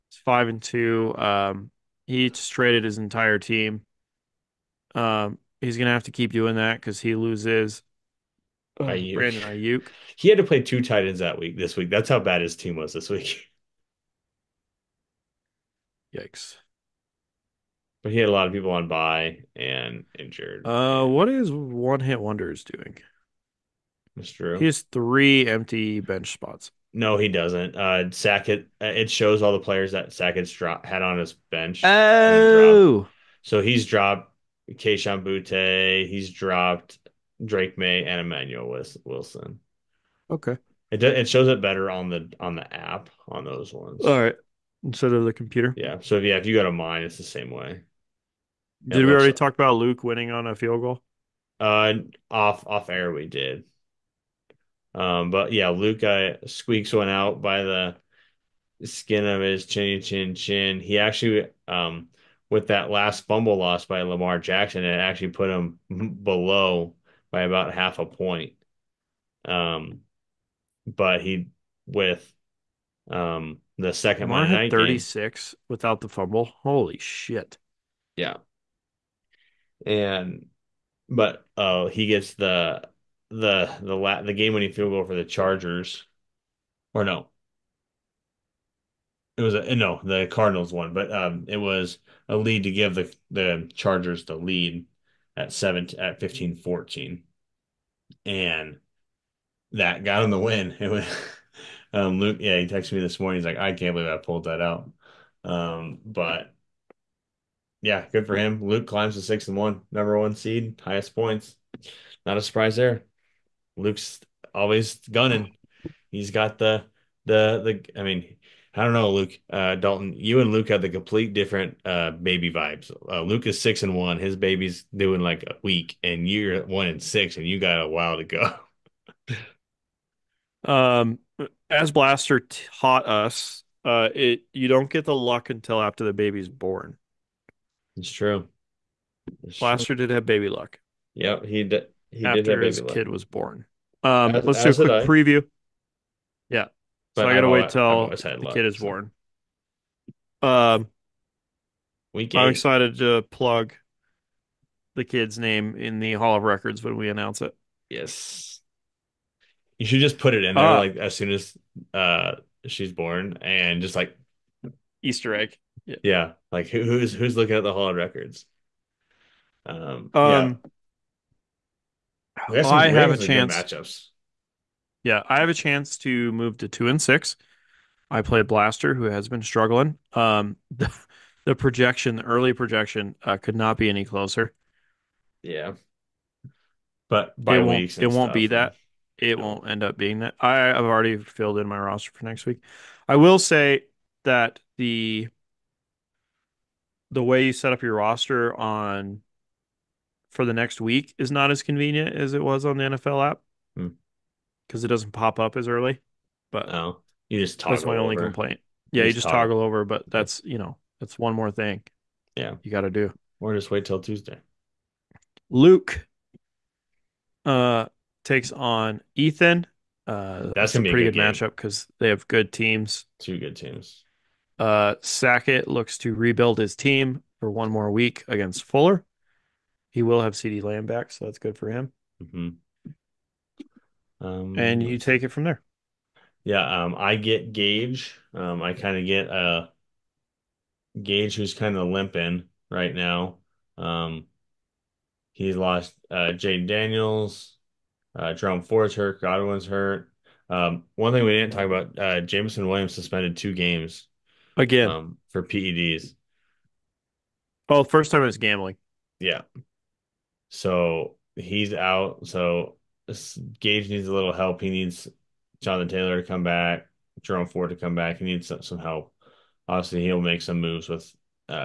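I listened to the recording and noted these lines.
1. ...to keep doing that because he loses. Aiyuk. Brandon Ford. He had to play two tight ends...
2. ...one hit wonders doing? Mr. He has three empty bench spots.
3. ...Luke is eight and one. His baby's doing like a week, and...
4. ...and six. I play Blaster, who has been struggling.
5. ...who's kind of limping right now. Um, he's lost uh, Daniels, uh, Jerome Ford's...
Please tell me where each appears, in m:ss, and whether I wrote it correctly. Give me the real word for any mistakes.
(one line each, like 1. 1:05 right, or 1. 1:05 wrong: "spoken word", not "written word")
1. 0:06 wrong: "Aiyuk", not "Ford"
2. 0:21 right
3. 2:03 wrong: "six", not "eight"
4. 2:56 right
5. 4:01 right.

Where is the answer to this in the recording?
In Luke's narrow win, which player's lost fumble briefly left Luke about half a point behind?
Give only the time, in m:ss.
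1:04.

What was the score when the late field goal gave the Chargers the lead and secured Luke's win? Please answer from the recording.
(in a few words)
15-14.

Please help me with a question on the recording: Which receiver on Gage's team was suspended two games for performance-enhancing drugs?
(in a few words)
Jameson Williams.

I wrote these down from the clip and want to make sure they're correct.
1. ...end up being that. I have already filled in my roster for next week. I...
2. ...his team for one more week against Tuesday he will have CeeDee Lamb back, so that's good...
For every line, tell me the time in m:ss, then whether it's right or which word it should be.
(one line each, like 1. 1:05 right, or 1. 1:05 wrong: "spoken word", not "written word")
1. 3:09 right
2. 3:46 wrong: "Fuller", not "Tuesday".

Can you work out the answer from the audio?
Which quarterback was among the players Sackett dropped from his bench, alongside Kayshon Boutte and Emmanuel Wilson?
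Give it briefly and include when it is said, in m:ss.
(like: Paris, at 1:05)
Drake Maye, at 0:37.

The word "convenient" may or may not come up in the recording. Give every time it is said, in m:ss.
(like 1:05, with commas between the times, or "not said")
3:21.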